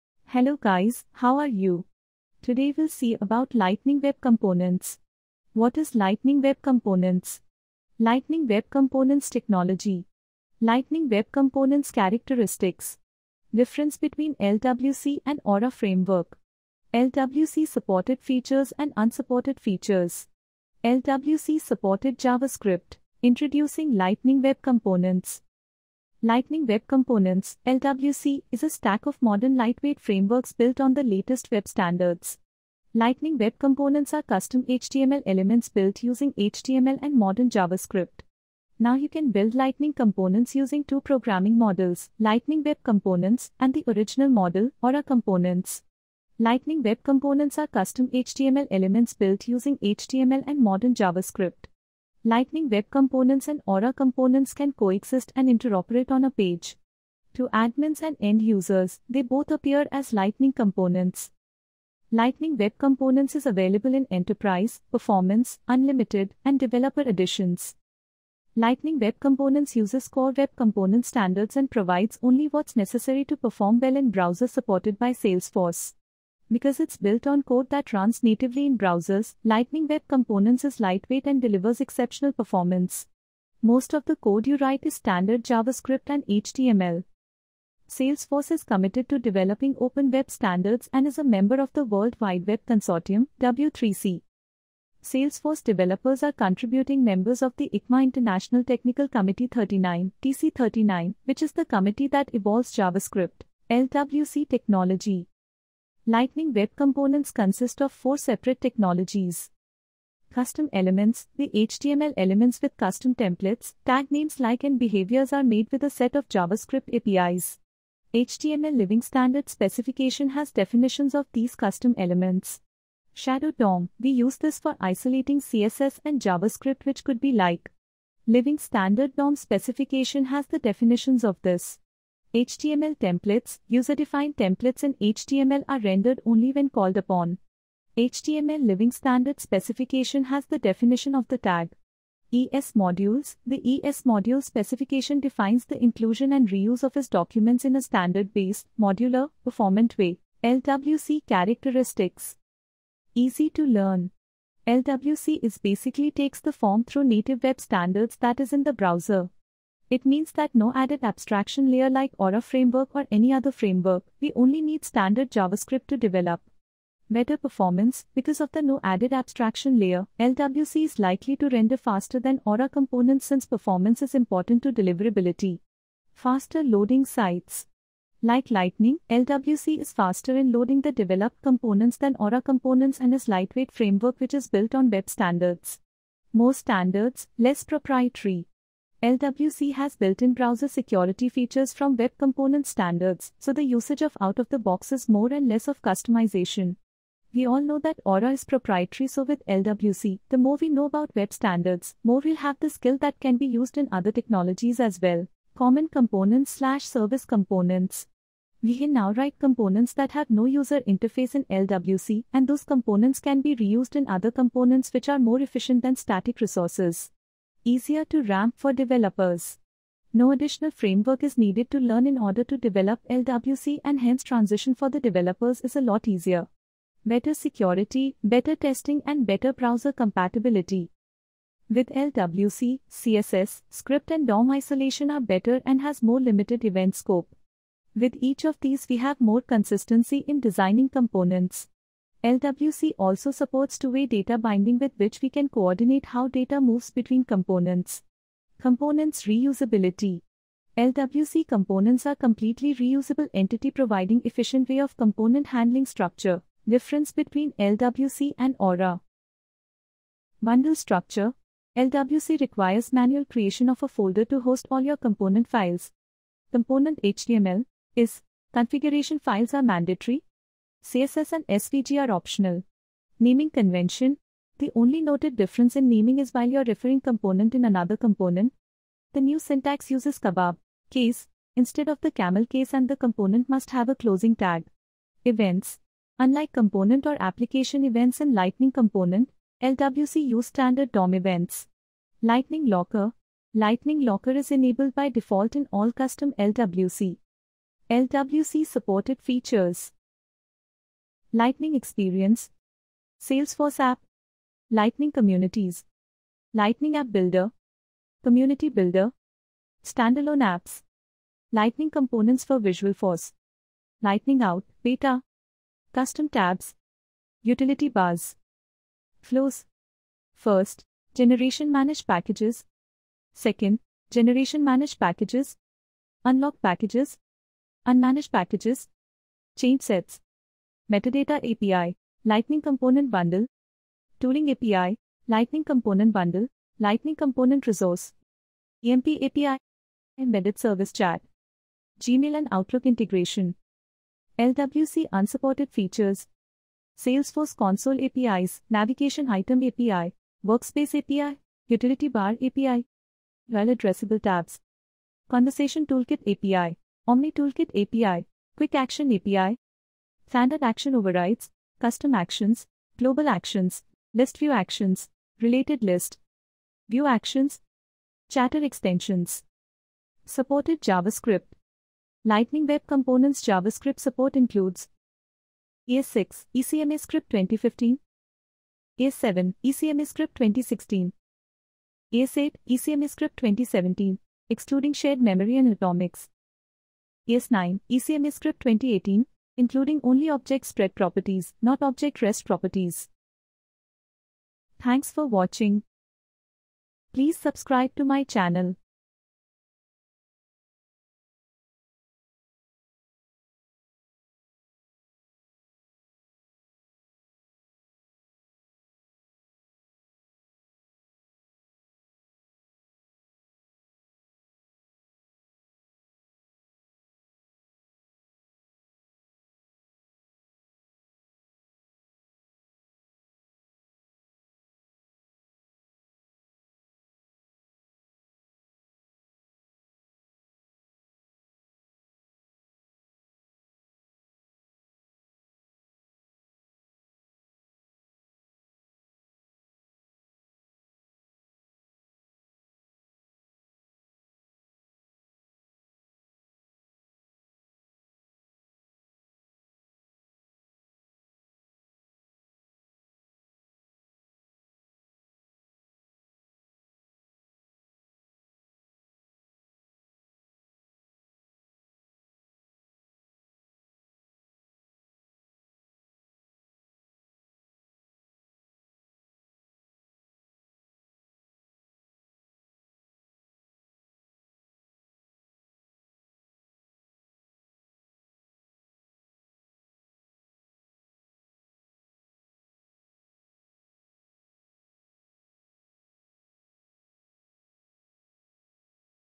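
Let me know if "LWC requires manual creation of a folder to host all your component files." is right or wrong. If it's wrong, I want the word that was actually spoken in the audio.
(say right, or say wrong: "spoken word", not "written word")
right.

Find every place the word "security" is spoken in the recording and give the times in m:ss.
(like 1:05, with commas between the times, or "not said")
3:10, 3:47.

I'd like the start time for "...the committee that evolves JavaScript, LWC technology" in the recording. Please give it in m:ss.
1:41.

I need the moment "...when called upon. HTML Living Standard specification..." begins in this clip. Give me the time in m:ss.
2:16.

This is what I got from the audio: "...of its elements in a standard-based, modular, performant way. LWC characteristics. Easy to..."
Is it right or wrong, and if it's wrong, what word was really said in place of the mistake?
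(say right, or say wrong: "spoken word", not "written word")
wrong: "documents", not "elements".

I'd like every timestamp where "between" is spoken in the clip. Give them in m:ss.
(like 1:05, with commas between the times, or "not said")
0:13, 4:06, 4:17.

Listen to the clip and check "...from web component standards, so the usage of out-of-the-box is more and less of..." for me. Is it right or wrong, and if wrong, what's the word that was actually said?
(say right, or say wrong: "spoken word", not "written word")
right.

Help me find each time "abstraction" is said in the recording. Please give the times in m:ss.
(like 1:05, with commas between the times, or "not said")
2:41, 2:49.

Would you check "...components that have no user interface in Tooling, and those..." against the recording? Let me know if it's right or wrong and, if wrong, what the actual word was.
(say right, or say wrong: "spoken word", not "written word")
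wrong: "LWC", not "Tooling".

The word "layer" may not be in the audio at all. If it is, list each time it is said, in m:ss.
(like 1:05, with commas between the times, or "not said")
2:41, 2:49.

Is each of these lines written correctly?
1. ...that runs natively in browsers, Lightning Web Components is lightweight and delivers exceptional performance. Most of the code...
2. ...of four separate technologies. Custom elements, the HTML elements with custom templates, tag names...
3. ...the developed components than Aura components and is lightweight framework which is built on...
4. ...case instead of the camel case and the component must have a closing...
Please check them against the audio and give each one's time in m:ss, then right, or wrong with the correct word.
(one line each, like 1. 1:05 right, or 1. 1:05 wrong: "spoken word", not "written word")
1. 1:17 right
2. 1:47 right
3. 3:00 right
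4. 4:40 right.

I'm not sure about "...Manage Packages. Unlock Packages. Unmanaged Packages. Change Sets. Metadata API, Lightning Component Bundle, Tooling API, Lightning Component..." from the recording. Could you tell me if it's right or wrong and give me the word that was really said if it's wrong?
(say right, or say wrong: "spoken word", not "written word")
right.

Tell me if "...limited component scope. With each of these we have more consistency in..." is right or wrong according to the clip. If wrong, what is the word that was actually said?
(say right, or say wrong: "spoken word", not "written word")
wrong: "event", not "component".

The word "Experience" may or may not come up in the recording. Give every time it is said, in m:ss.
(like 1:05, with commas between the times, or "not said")
5:01.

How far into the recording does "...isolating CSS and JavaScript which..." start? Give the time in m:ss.
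2:04.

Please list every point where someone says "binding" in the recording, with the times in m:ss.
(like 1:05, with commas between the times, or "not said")
4:04.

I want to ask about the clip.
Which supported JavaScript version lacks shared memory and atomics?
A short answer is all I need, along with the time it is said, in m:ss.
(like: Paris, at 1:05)
ES8 ECMAScript 2017, at 6:22.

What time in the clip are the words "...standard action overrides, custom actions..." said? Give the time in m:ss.
6:00.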